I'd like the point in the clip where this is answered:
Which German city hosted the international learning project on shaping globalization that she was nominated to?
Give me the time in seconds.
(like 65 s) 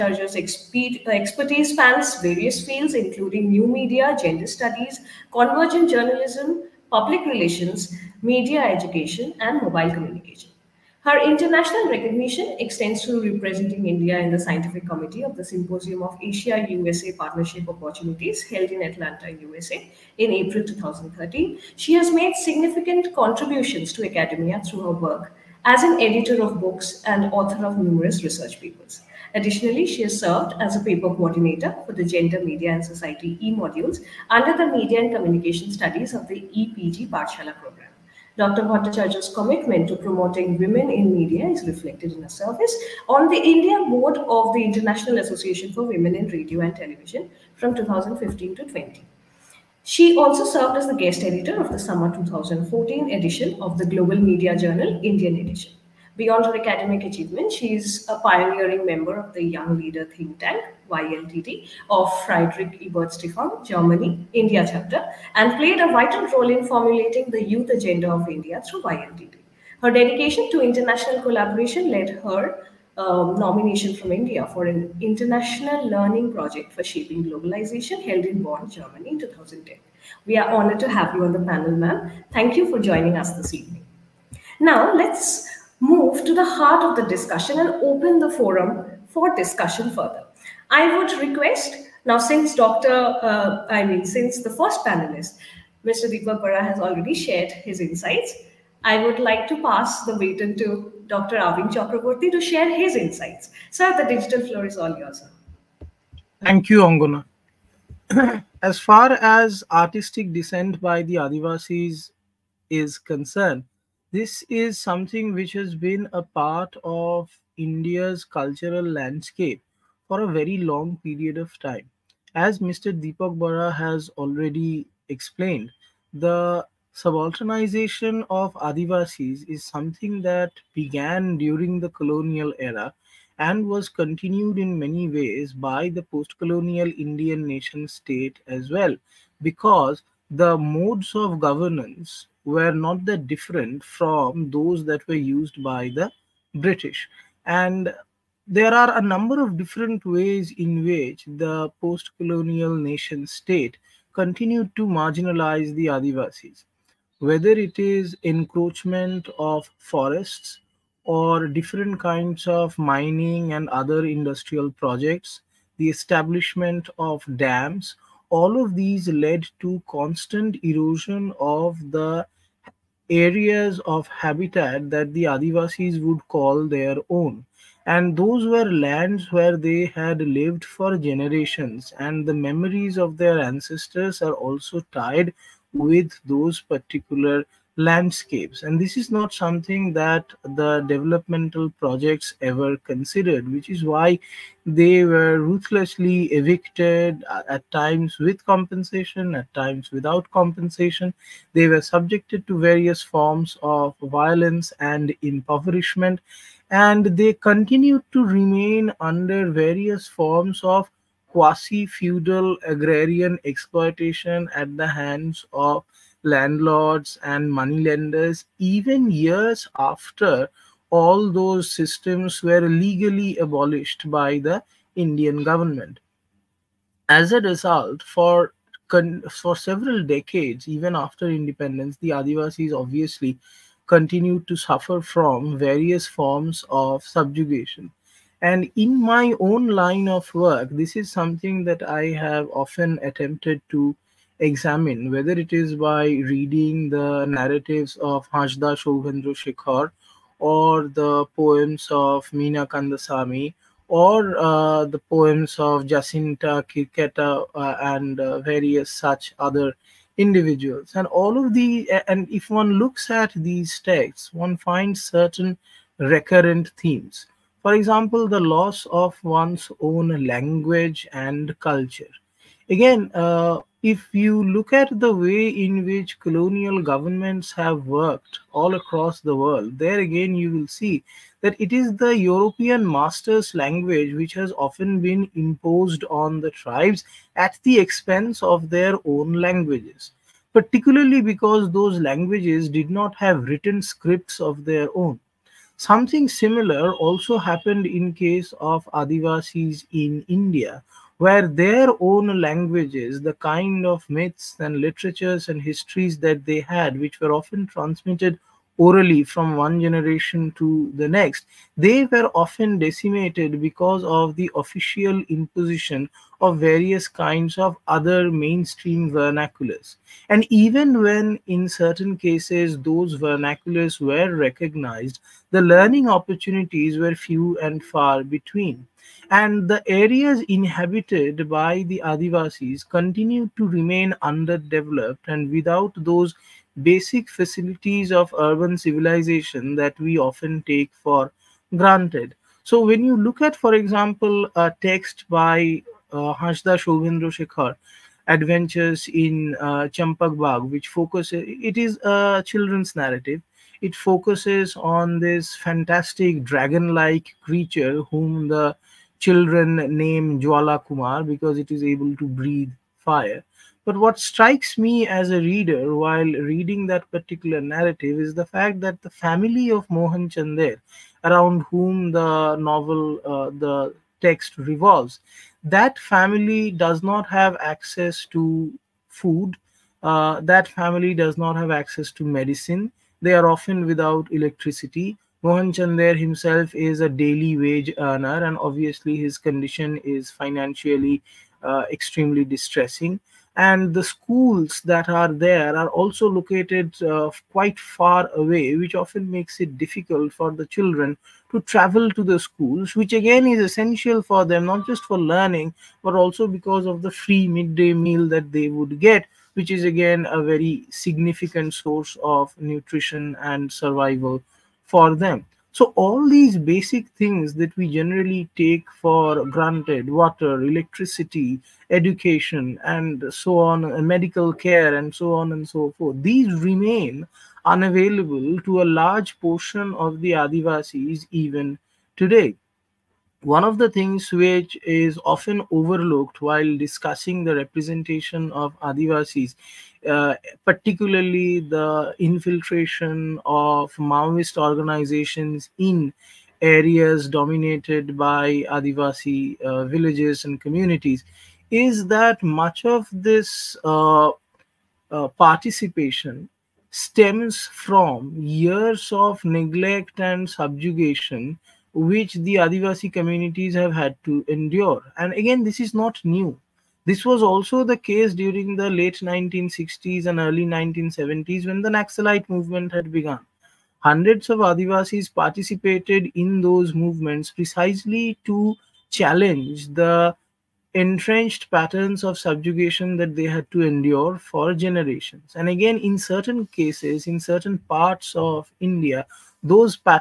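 78 s.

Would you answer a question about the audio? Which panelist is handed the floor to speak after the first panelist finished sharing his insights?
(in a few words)
Arvind Chakraborty.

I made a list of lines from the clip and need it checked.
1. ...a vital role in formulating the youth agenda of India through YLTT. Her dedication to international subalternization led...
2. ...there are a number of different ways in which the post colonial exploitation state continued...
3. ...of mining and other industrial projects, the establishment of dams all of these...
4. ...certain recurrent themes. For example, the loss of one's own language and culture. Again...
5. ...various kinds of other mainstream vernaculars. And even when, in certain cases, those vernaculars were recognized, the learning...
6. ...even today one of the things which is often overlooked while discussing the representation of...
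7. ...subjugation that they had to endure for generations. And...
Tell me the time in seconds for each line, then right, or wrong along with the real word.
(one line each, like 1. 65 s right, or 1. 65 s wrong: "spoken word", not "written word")
1. 65 s wrong: "collaboration", not "subalternization"
2. 148 s wrong: "nation", not "exploitation"
3. 162 s right
4. 265 s right
5. 316 s right
6. 431 s right
7. 482 s right.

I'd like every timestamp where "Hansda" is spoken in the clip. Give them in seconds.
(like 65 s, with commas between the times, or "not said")
248 s, 346 s.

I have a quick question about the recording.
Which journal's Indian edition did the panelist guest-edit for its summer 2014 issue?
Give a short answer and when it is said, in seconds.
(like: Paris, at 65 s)
Global Media Journal, at 53 s.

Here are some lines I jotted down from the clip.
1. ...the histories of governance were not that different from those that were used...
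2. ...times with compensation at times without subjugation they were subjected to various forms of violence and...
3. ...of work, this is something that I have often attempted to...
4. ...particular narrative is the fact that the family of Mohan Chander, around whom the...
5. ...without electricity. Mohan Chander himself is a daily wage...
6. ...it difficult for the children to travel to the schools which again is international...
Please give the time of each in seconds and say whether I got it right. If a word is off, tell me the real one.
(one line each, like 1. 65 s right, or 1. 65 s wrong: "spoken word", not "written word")
1. 140 s wrong: "modes", not "histories"
2. 197 s wrong: "compensation", not "subjugation"
3. 240 s right
4. 367 s right
5. 383 s right
6. 399 s wrong: "essential", not "international".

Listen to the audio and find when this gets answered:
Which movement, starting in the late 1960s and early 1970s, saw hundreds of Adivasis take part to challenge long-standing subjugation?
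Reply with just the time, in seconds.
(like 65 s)
471 s.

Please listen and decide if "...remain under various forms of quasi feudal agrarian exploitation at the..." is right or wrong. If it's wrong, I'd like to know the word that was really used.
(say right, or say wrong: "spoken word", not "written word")
right.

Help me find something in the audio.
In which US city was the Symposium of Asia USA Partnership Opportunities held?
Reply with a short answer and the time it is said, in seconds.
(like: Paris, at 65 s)
Atlanta, at 18 s.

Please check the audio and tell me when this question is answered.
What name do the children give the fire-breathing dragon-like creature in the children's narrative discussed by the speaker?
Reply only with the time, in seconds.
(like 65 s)
360 s.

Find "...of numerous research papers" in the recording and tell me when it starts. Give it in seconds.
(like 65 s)
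27 s.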